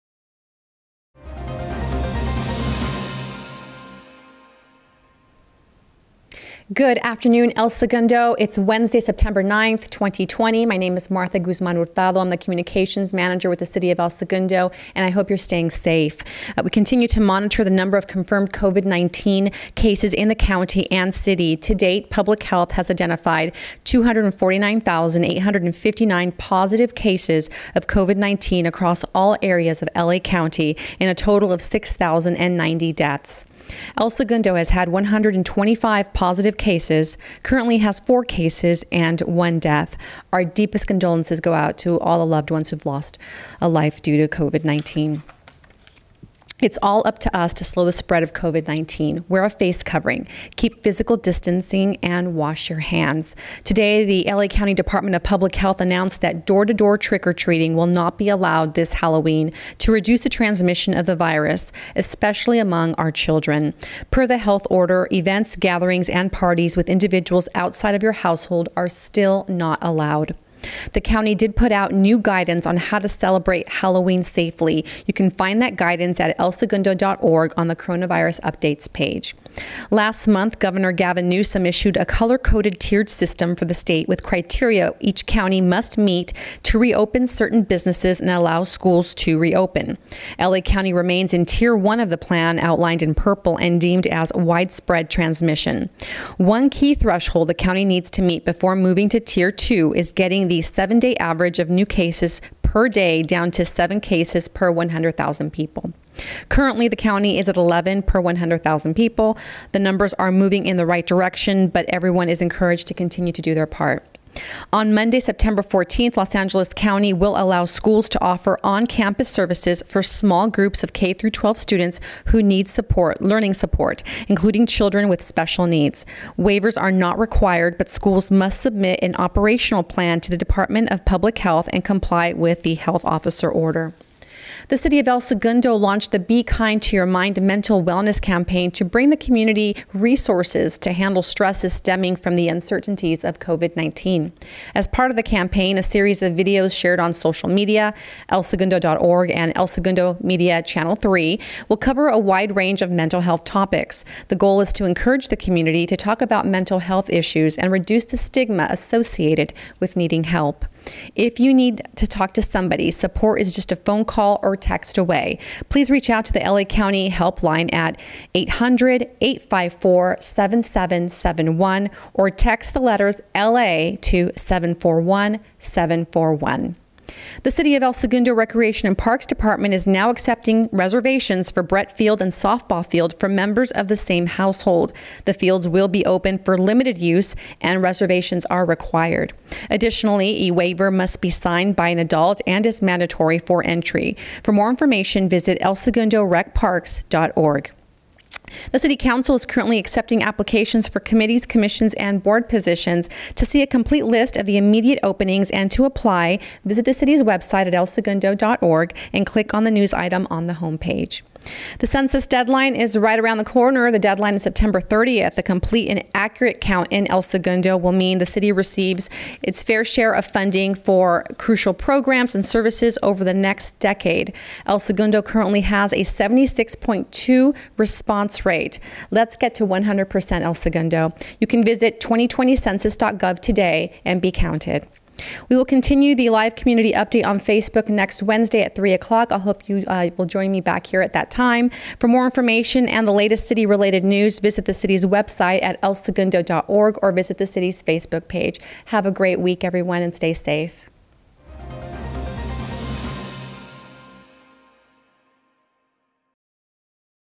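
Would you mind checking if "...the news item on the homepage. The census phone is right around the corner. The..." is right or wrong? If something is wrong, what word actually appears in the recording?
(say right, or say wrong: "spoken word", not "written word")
wrong: "deadline", not "phone".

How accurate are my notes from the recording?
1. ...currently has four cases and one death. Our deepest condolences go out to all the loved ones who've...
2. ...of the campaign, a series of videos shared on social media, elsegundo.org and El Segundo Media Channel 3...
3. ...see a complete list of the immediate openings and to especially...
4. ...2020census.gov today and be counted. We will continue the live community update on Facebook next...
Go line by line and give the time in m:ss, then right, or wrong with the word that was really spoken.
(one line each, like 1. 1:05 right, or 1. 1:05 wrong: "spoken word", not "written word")
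1. 0:37 right
2. 2:25 right
3. 3:23 wrong: "apply", not "especially"
4. 3:51 right.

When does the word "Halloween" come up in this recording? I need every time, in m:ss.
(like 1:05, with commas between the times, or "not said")
0:58, 1:13.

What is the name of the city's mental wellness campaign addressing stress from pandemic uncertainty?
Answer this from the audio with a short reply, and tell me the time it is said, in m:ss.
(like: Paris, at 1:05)
Be Kind to Your Mind, at 2:16.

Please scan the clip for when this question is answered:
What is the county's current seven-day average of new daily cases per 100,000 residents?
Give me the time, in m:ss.
1:47.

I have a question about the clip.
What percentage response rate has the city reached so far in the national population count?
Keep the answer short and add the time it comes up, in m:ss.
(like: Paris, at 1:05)
76.2, at 3:46.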